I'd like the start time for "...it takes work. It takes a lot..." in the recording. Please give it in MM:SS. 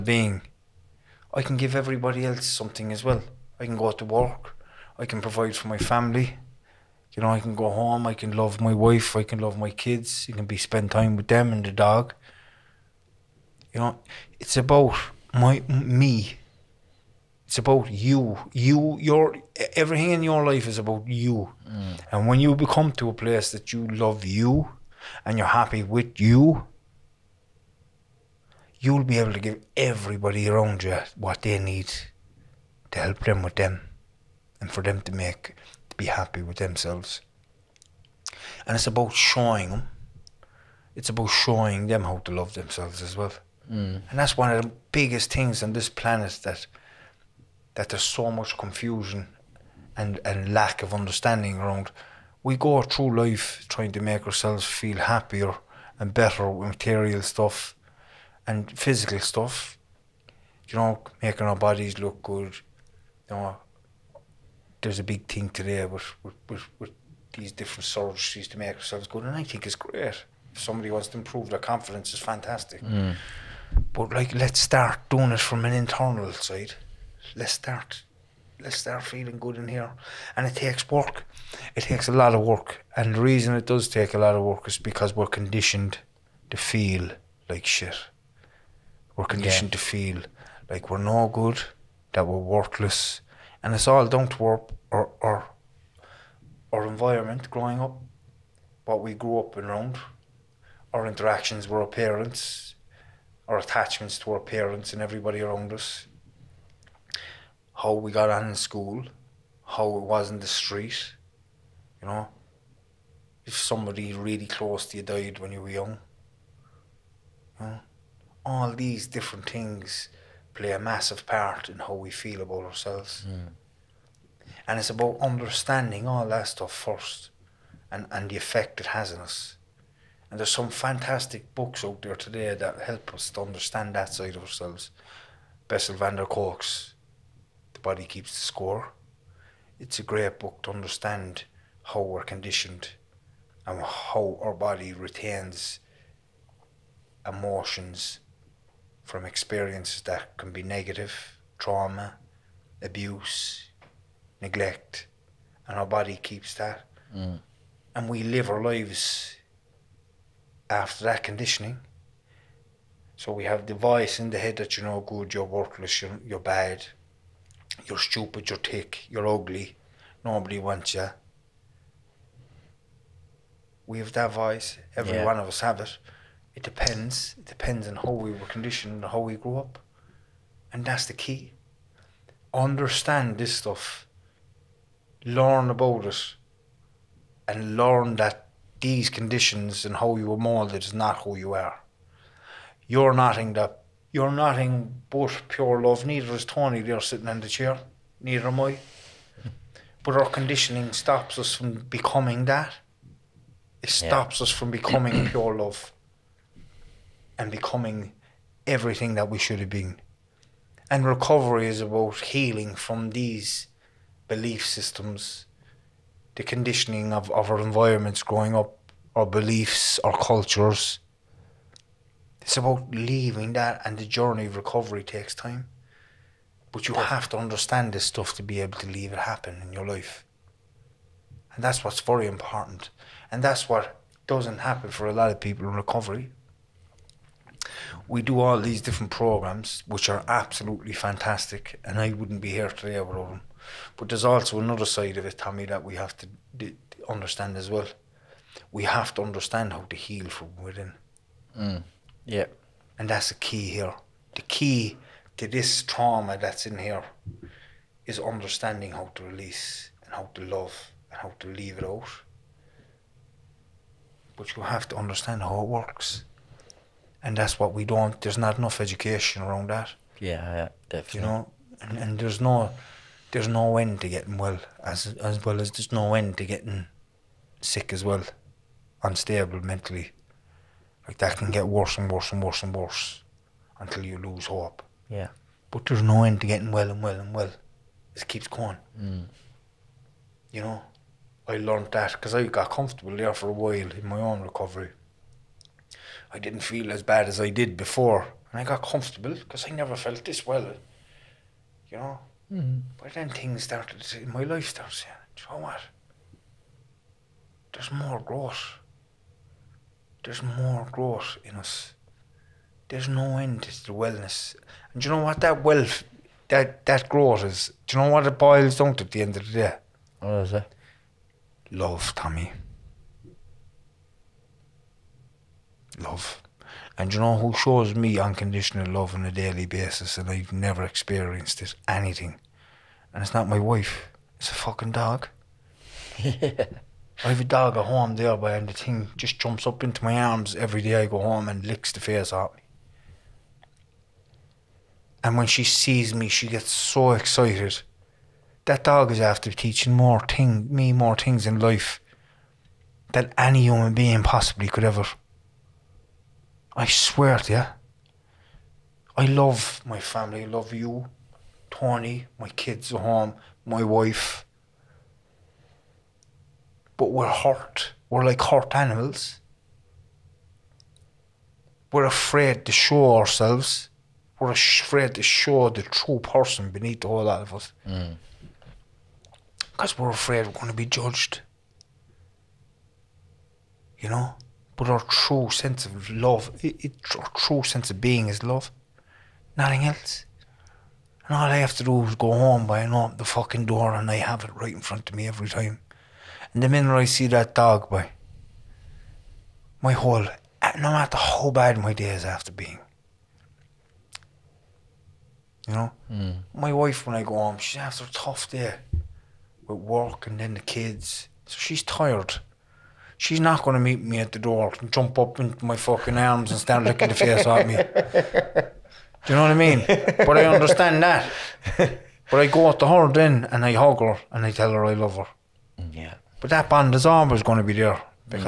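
01:20.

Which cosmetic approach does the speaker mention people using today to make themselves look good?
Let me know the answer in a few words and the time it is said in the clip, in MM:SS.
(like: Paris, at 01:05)
Surgeries, at 01:07.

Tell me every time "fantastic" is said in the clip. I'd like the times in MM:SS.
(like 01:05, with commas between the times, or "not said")
01:12, 02:10, 04:00.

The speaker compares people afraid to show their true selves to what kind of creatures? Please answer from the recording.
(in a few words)
Hurt animals.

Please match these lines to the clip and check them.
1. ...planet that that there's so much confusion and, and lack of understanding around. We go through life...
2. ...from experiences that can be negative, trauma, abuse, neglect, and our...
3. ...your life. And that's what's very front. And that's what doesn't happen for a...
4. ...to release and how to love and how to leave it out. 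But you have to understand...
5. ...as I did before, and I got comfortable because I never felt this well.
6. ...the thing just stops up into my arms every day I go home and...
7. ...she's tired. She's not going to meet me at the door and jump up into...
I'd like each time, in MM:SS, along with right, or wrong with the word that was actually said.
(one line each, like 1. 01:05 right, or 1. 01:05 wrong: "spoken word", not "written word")
1. 00:45 right
2. 02:29 right
3. 03:49 wrong: "important", not "front"
4. 04:19 right
5. 04:57 right
6. 05:38 wrong: "jumps", not "stops"
7. 06:51 right.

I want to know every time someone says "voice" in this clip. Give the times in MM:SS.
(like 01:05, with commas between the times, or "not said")
02:43, 02:54.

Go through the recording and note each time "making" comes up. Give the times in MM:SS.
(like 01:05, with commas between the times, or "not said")
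01:01.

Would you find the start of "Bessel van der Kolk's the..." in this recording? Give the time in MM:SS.
02:15.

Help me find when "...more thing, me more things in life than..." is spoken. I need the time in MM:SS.
05:49.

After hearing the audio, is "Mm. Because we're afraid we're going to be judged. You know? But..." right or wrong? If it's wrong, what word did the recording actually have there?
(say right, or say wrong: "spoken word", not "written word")
right.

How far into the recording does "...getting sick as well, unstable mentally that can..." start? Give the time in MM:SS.
04:36.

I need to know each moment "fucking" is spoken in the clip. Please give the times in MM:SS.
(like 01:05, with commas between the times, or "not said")
05:34, 06:33, 06:55.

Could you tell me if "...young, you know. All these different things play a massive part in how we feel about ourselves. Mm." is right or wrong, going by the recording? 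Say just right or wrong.
right.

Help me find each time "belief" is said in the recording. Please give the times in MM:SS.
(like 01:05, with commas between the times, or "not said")
03:34, 03:39.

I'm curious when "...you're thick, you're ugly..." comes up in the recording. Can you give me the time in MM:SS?
02:48.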